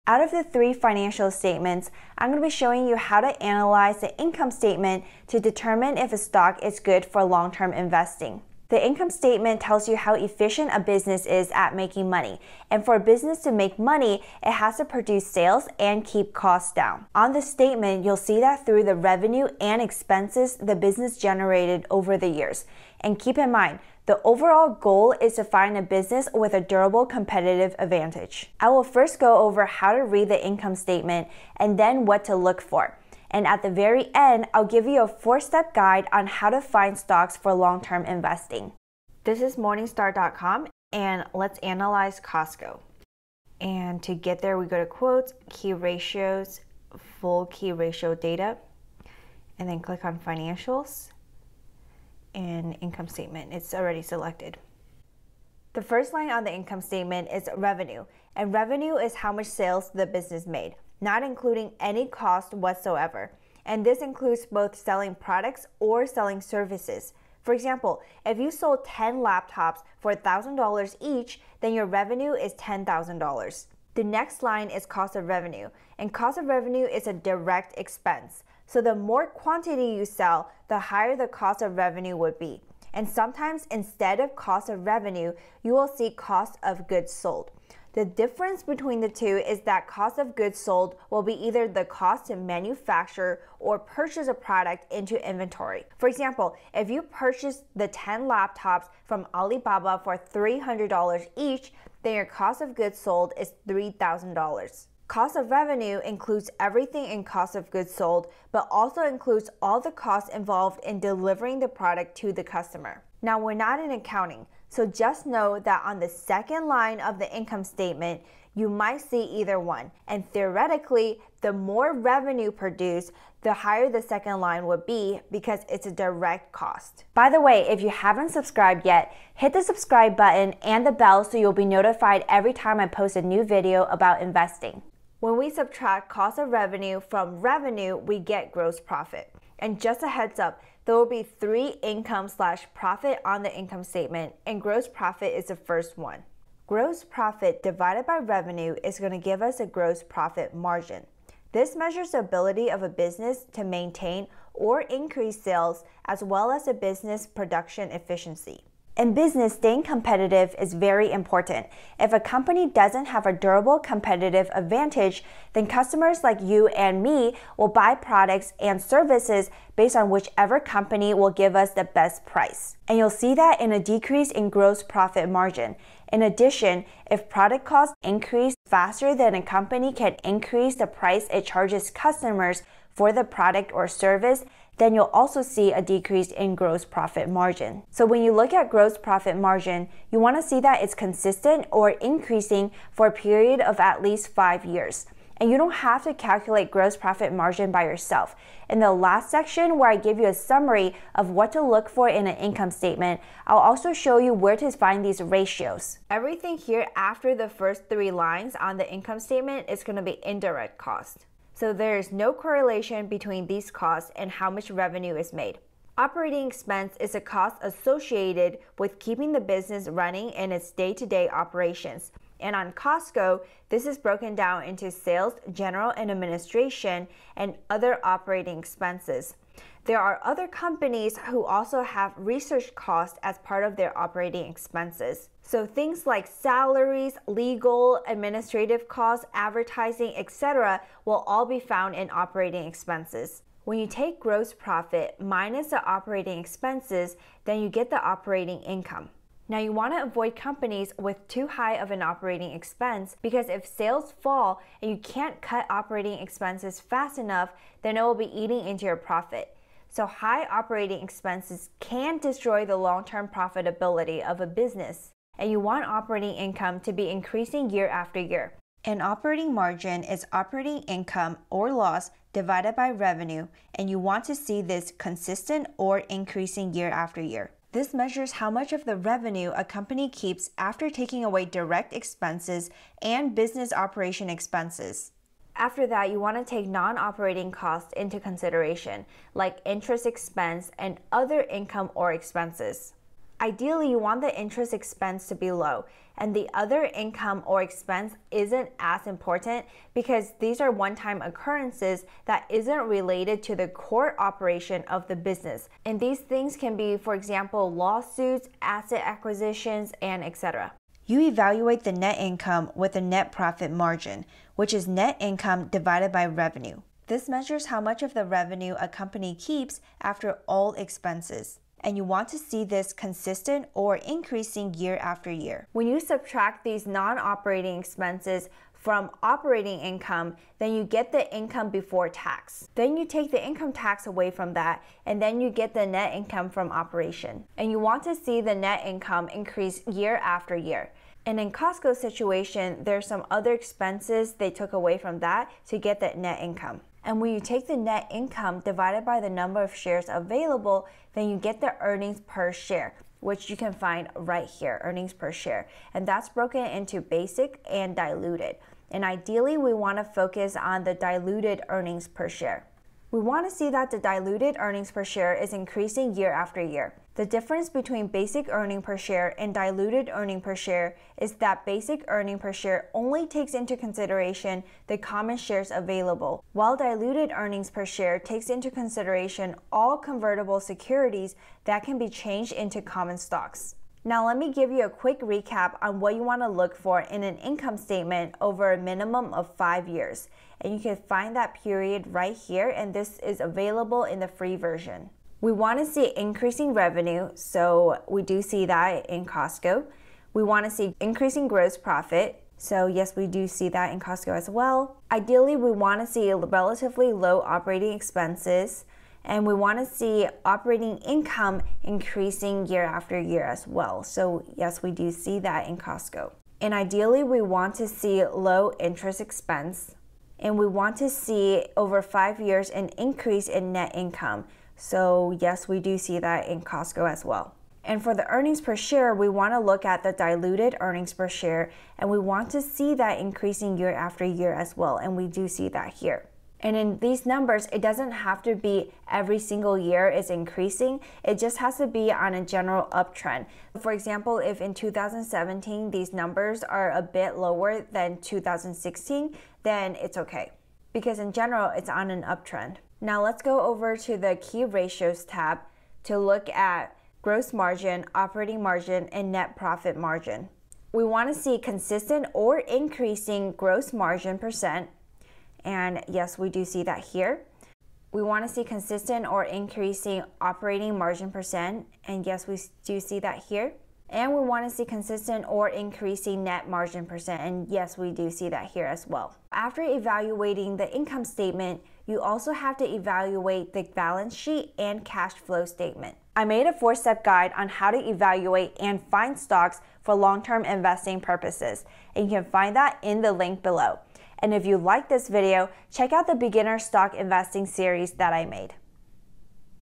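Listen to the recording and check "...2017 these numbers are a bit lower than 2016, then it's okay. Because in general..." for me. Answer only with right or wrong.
right.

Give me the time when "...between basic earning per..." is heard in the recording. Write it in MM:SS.
06:07.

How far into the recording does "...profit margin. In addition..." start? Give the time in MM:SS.
02:54.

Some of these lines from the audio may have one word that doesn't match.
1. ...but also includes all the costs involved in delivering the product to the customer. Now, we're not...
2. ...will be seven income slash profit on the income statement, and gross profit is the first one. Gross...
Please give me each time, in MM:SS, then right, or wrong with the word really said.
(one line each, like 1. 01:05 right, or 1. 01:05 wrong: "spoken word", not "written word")
1. 01:48 right
2. 02:20 wrong: "three", not "seven".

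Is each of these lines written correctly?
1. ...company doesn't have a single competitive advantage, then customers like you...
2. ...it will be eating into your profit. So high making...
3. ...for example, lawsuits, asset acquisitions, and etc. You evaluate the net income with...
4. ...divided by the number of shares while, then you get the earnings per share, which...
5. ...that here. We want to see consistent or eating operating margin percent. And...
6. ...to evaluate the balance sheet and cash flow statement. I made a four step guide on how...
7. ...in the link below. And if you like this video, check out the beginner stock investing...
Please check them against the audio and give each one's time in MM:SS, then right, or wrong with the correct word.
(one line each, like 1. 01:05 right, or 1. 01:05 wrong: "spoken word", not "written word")
1. 02:42 wrong: "durable", not "single"
2. 04:17 wrong: "operating", not "making"
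3. 05:06 right
4. 05:48 wrong: "available", not "while"
5. 07:46 wrong: "increasing", not "eating"
6. 08:02 right
7. 08:13 right.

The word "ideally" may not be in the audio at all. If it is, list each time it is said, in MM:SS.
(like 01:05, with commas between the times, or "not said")
04:53, 05:59, 06:45, 06:56.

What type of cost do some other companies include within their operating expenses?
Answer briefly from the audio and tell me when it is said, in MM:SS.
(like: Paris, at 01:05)
research costs, at 03:52.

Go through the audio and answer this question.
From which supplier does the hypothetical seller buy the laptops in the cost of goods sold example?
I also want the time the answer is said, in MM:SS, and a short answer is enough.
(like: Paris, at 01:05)
Alibaba, at 01:39.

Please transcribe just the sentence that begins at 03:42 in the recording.
And on Costco, this is broken down into sales, general and administration, and other operating expenses.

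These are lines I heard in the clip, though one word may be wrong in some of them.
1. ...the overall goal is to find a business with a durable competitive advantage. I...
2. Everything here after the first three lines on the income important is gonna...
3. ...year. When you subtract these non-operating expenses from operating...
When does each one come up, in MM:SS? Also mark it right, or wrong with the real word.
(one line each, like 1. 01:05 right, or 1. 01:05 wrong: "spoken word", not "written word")
1. 00:24 right
2. 03:26 wrong: "statement", not "important"
3. 05:25 right.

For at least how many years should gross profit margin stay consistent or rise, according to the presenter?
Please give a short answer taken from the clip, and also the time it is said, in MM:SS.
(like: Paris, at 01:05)
5 years, at 03:13.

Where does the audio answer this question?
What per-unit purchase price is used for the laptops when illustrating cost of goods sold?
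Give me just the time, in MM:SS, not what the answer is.
01:40.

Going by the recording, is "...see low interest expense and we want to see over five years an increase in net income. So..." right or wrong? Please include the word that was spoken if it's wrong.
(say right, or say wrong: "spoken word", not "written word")
right.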